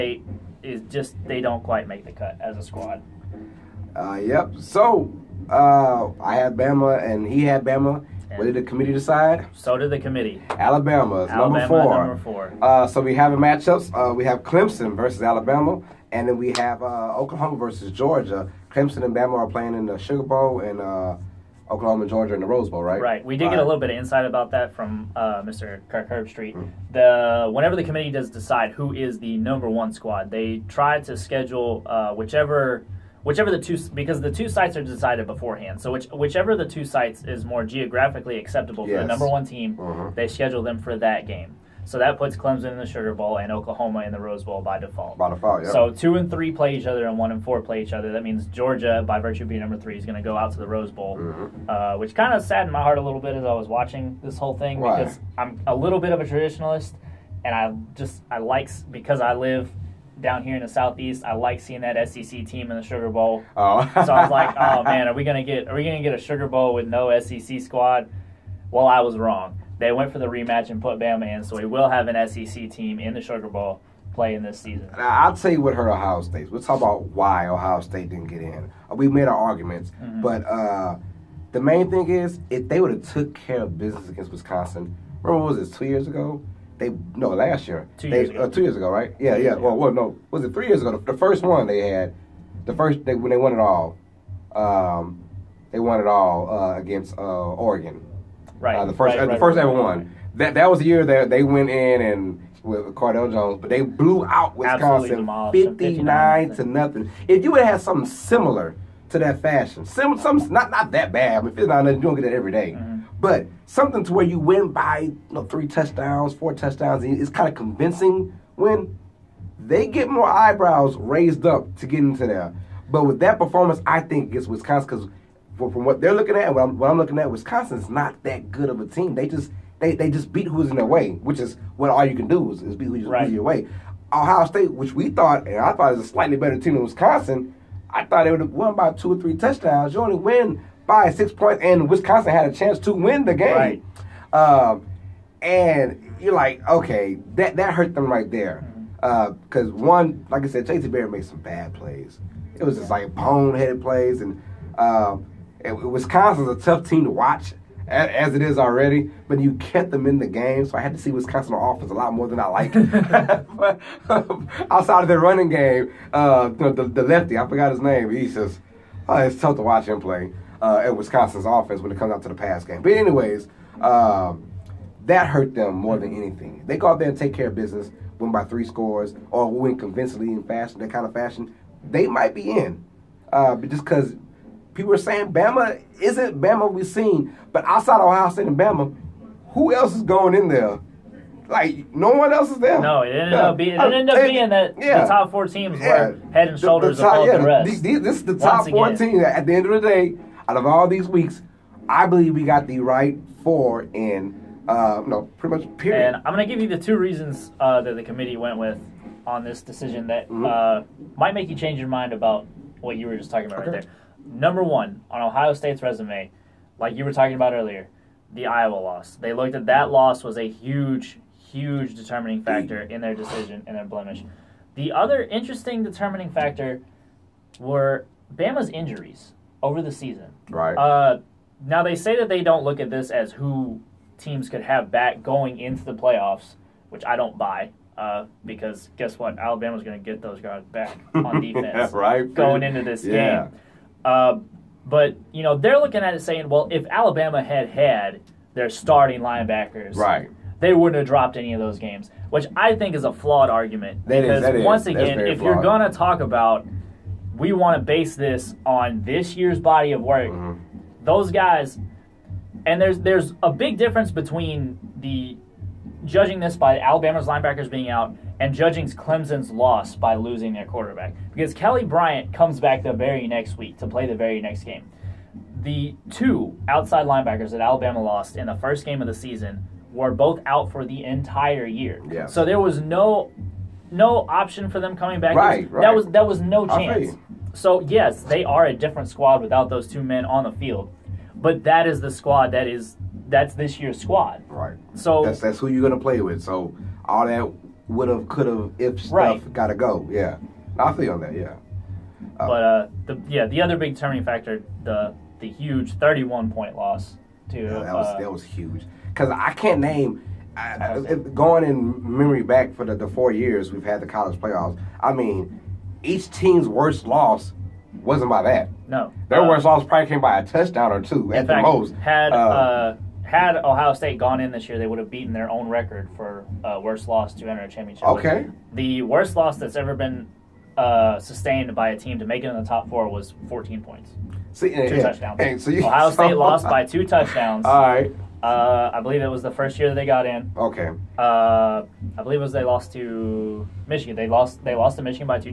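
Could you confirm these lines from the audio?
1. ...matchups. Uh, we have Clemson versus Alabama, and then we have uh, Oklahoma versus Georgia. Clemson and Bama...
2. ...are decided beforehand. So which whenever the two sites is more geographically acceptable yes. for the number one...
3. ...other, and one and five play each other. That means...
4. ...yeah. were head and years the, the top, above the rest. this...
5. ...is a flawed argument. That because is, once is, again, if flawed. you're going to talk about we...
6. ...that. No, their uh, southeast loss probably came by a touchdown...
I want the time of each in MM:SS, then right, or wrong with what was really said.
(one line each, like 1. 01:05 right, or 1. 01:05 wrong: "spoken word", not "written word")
1. 00:13 right
2. 00:34 wrong: "whichever", not "whenever"
3. 00:46 wrong: "four", not "five"
4. 03:15 wrong: "shoulders", not "years"
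5. 04:12 right
6. 05:18 wrong: "worst", not "southeast".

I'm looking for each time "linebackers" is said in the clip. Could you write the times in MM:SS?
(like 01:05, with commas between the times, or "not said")
04:09, 04:27, 04:37.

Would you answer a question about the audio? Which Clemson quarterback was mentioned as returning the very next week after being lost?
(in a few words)
Kelly Bryant.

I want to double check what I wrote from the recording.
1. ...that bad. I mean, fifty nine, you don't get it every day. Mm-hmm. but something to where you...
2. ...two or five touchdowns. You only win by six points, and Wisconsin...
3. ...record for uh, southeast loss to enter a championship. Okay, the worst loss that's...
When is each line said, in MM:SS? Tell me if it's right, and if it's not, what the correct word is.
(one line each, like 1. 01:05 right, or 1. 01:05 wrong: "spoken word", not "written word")
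1. 01:50 right
2. 02:18 wrong: "three", not "five"
3. 05:25 wrong: "worst", not "southeast".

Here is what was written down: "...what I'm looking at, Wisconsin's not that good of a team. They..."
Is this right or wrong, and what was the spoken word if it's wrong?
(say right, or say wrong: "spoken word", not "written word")
right.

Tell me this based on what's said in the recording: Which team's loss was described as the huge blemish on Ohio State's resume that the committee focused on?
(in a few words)
Iowa.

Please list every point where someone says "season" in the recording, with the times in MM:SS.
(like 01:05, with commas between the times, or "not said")
01:14, 03:49, 04:39.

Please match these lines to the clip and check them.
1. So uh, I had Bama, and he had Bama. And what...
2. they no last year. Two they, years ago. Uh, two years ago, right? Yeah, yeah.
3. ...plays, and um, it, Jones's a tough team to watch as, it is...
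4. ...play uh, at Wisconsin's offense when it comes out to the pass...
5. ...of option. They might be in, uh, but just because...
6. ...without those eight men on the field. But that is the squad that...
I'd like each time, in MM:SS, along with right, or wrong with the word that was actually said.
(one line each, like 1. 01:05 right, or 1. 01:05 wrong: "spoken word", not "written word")
1. 00:04 right
2. 01:26 right
3. 02:33 wrong: "Wisconsin", not "Jones"
4. 02:49 right
5. 03:01 wrong: "fashion", not "option"
6. 04:49 wrong: "two", not "eight".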